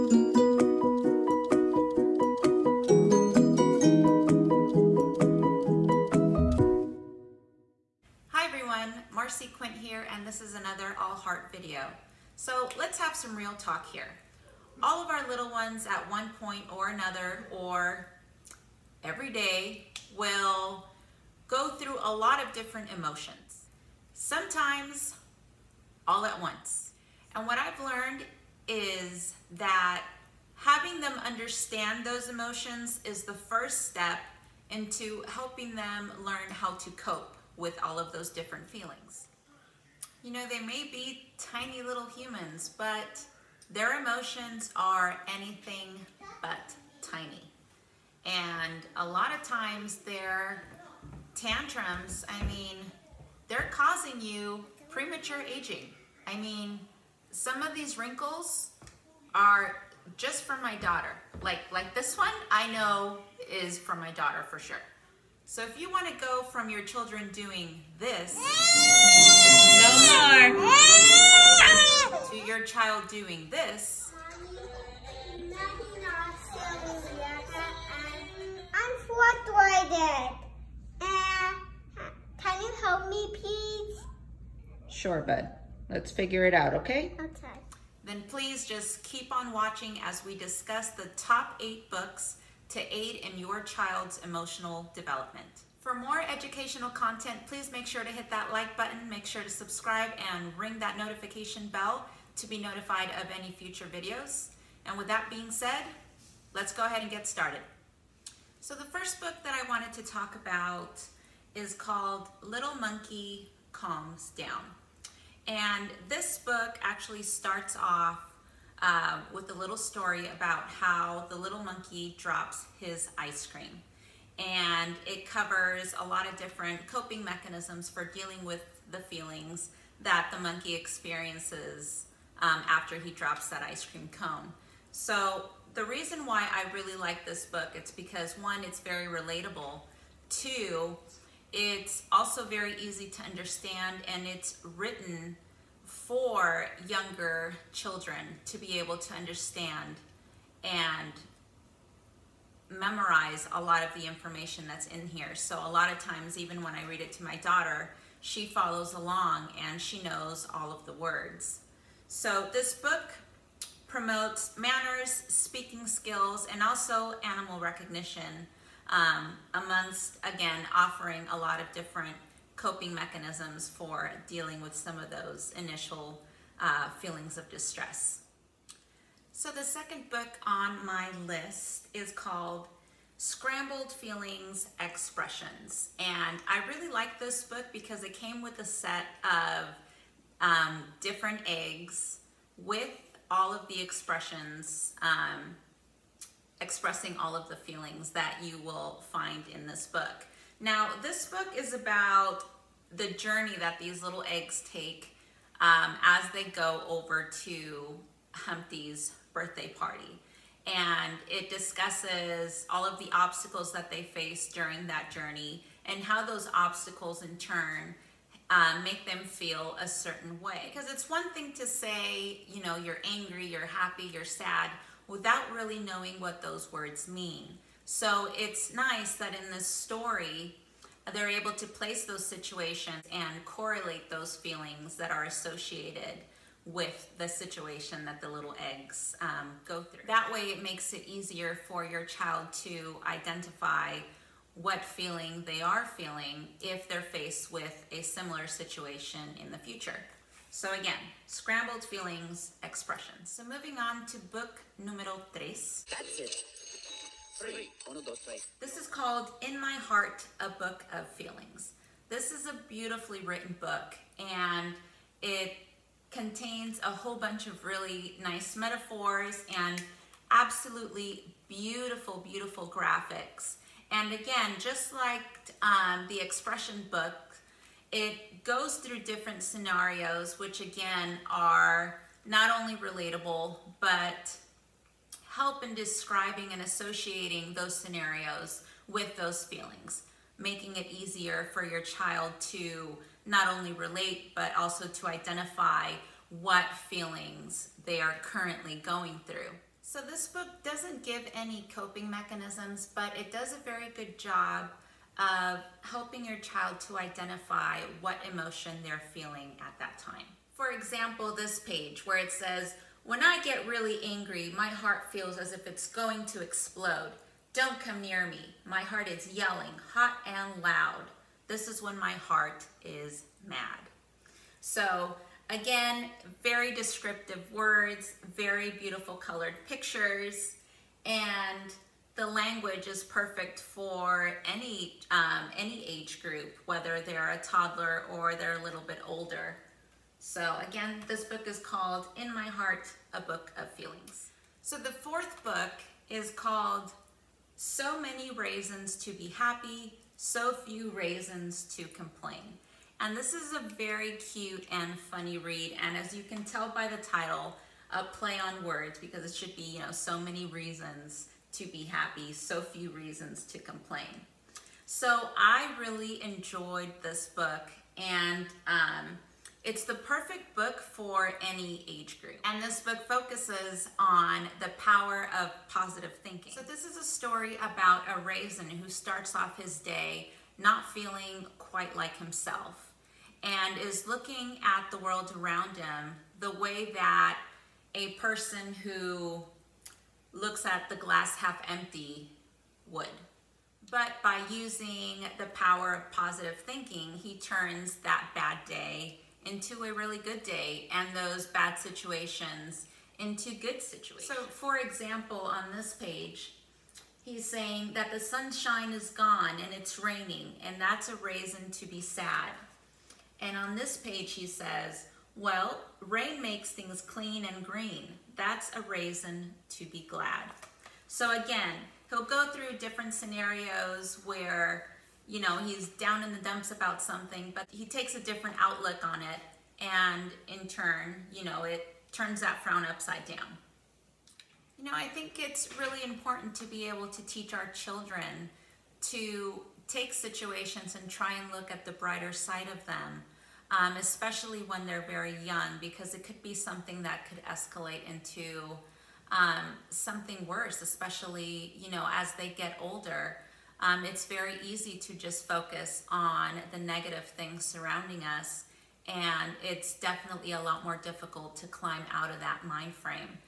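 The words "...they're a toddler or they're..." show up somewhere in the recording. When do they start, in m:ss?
5:36.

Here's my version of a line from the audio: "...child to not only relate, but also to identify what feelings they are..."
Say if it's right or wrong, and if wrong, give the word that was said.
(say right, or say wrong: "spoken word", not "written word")
right.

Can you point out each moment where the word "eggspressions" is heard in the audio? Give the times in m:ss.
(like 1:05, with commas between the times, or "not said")
3:04, 4:12.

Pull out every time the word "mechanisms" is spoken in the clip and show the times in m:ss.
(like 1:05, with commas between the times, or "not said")
2:07, 2:52, 5:02.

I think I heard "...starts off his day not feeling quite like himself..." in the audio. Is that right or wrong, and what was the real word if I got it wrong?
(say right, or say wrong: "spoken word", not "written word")
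right.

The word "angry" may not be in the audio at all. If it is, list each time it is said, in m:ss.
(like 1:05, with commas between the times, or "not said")
3:43, 5:14.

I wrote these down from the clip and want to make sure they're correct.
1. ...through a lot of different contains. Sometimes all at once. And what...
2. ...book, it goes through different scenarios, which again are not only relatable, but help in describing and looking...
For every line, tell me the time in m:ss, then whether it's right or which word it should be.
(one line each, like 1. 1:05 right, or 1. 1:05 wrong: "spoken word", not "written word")
1. 0:21 wrong: "emotions", not "contains"
2. 4:36 wrong: "associating", not "looking".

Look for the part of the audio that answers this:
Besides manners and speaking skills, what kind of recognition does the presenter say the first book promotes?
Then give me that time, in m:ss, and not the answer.
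2:47.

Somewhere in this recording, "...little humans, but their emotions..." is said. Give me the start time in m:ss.
0:41.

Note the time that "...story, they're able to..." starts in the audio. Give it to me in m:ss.
3:49.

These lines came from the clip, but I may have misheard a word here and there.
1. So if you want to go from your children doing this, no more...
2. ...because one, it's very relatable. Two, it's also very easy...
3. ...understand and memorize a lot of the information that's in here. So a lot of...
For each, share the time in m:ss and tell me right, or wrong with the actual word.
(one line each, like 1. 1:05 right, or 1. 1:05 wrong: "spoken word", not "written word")
1. 1:05 right
2. 2:17 right
3. 2:29 right.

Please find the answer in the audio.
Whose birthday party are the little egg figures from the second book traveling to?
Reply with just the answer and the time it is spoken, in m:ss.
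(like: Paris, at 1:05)
Humpty's, at 3:28.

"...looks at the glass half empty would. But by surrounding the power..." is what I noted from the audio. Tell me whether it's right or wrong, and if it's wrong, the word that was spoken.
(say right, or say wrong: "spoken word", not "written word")
wrong: "using", not "surrounding".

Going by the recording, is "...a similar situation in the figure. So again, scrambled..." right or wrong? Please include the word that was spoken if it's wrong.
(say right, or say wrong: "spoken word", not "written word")
wrong: "future", not "figure".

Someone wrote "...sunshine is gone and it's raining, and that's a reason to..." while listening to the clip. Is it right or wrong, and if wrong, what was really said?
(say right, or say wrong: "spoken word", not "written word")
right.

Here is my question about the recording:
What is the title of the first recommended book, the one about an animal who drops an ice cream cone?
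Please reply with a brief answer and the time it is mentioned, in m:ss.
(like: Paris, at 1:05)
Little Monkey Calms Down, at 1:52.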